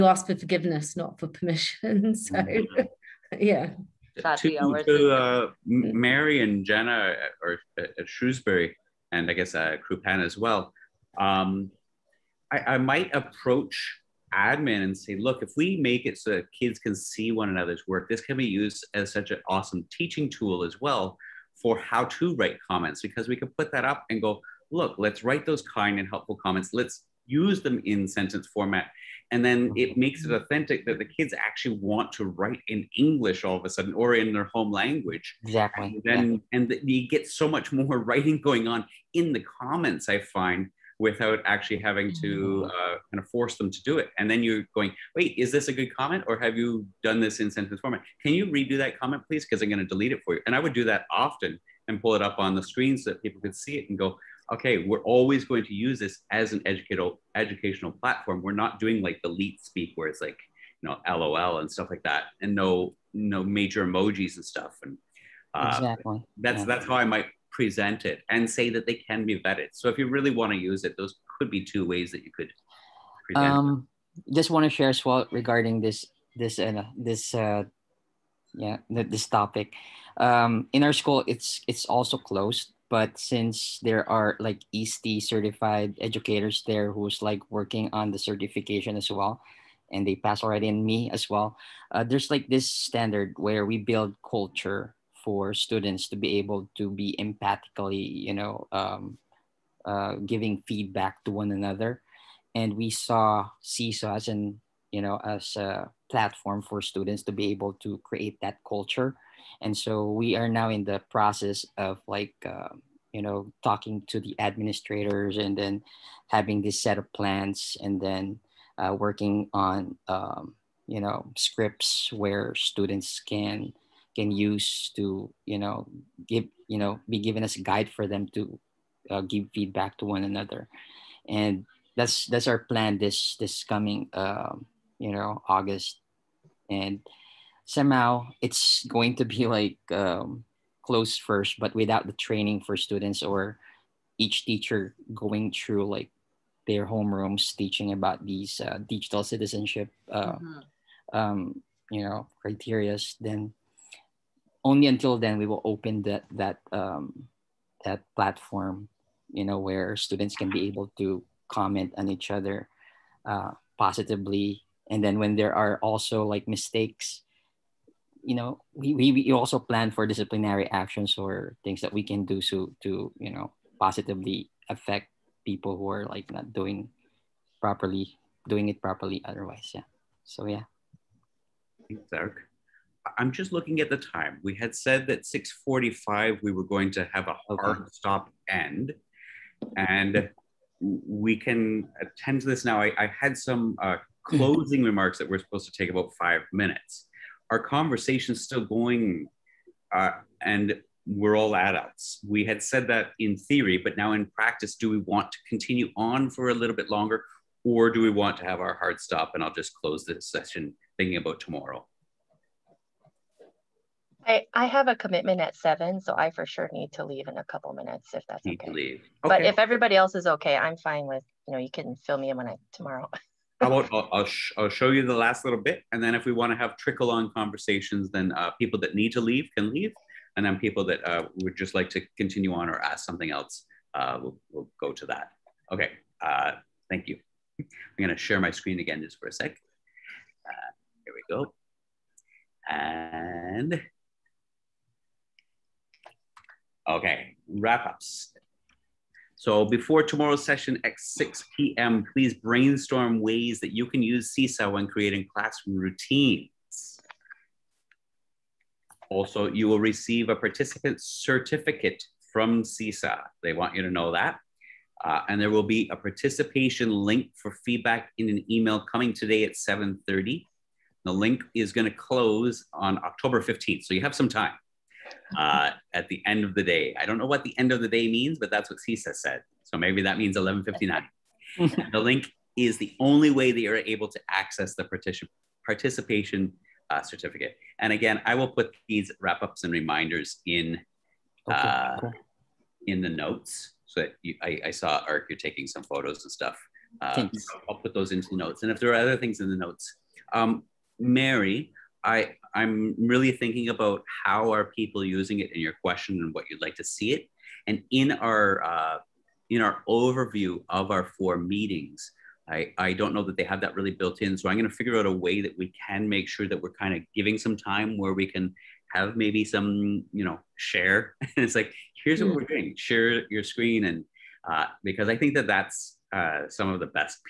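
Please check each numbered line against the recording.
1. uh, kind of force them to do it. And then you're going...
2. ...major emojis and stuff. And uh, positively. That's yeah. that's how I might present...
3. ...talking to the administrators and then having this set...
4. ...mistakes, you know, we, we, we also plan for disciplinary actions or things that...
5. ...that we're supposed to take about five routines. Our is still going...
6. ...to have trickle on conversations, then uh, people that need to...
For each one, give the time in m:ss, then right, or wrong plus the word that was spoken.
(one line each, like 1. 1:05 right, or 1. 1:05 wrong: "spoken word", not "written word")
1. 0:42 right
2. 1:03 wrong: "exactly", not "positively"
3. 1:53 right
4. 2:46 right
5. 3:15 wrong: "minutes", not "routines"
6. 3:46 right.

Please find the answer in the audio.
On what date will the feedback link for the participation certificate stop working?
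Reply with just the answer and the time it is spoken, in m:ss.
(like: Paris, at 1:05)
October 15, at 4:33.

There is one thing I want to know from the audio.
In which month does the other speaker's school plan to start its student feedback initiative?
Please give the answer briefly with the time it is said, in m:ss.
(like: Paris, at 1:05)
August, at 2:15.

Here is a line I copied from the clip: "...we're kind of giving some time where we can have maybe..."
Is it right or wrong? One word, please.
right.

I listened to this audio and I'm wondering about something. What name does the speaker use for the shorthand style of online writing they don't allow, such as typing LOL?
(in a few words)
leet speak.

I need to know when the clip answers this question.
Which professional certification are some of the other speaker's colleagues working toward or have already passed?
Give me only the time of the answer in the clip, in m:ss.
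1:24.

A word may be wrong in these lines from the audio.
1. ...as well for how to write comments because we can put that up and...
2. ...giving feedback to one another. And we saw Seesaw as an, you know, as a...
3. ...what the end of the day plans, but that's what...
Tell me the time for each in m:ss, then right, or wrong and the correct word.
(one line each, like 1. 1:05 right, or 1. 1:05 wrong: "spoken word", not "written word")
1. 0:20 right
2. 1:40 right
3. 4:37 wrong: "means", not "plans".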